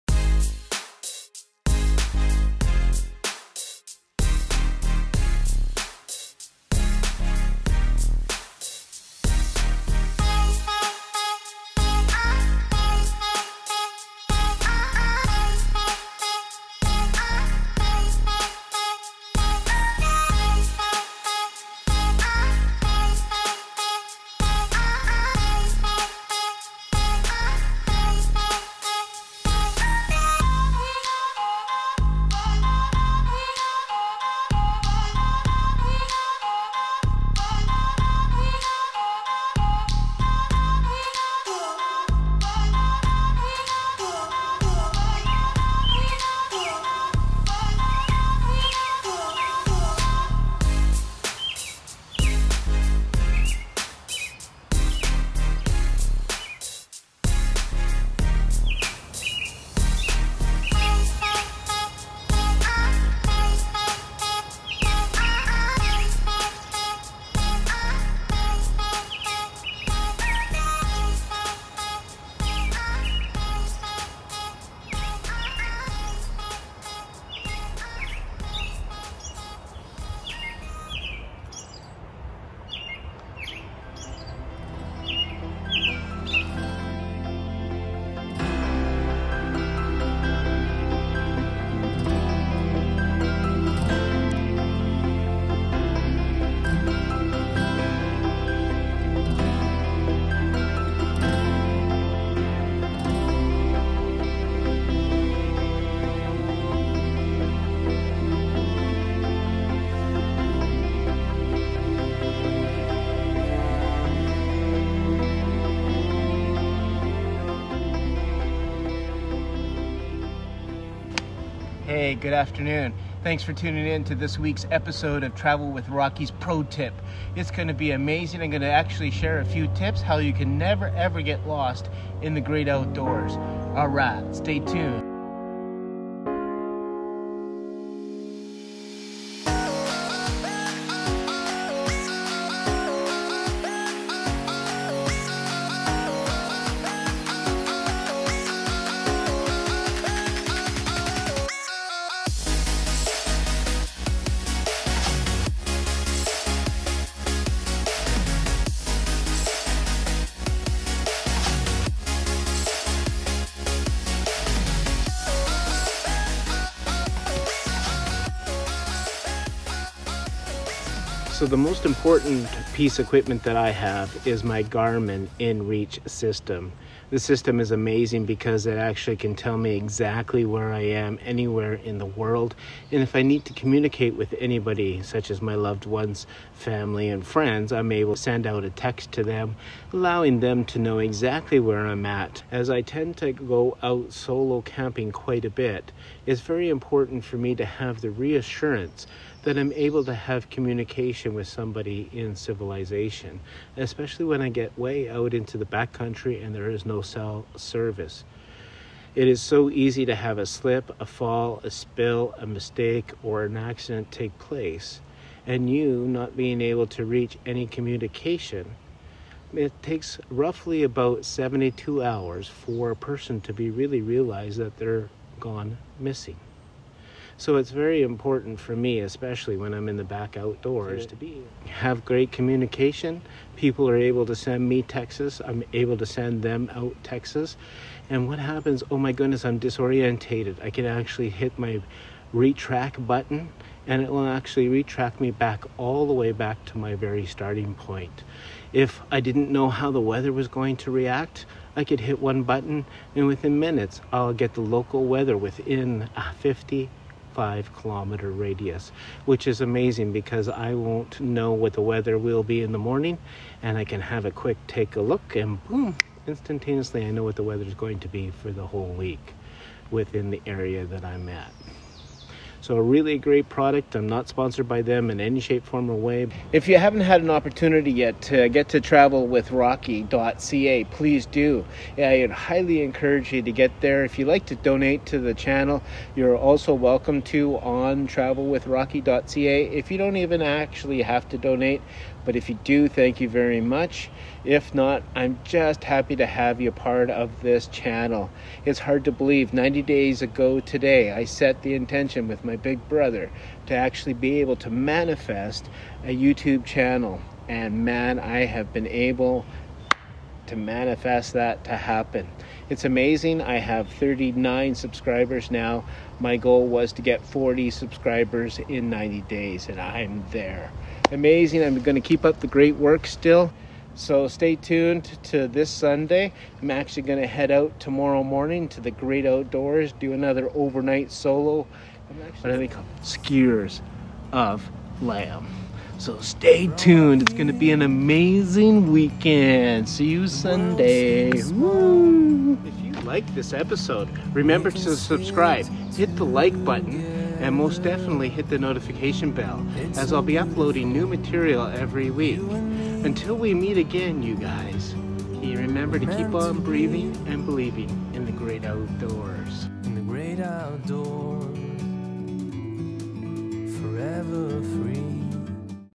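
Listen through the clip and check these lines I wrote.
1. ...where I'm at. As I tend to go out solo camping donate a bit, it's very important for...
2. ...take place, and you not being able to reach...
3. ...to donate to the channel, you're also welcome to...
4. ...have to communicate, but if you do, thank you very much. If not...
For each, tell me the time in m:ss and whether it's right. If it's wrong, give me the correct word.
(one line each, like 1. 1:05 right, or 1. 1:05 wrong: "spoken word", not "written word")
1. 3:11 wrong: "quite", not "donate"
2. 3:34 right
3. 4:44 right
4. 4:51 wrong: "donate", not "communicate".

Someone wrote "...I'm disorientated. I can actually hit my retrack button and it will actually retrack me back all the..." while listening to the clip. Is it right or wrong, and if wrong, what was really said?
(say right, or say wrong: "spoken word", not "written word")
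right.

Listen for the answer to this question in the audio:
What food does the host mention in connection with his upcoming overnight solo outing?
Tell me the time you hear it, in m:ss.
5:33.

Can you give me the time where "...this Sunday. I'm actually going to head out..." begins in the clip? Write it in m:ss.
5:25.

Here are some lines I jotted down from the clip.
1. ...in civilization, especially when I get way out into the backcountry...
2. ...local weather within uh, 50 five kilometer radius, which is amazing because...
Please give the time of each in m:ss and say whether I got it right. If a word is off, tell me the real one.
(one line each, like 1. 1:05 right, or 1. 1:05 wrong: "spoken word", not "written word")
1. 3:22 right
2. 4:14 right.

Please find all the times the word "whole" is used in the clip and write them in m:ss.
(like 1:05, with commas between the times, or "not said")
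4:28.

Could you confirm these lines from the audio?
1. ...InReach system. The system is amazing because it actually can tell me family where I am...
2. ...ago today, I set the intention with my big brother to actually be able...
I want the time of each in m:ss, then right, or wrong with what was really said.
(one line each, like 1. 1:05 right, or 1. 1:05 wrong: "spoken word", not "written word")
1. 2:55 wrong: "exactly", not "family"
2. 5:00 right.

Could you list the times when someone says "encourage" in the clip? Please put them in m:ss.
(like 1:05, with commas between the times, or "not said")
4:42.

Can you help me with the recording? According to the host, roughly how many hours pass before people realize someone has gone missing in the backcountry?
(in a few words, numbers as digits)
72.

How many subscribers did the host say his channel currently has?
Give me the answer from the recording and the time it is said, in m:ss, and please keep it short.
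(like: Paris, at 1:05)
39, at 5:13.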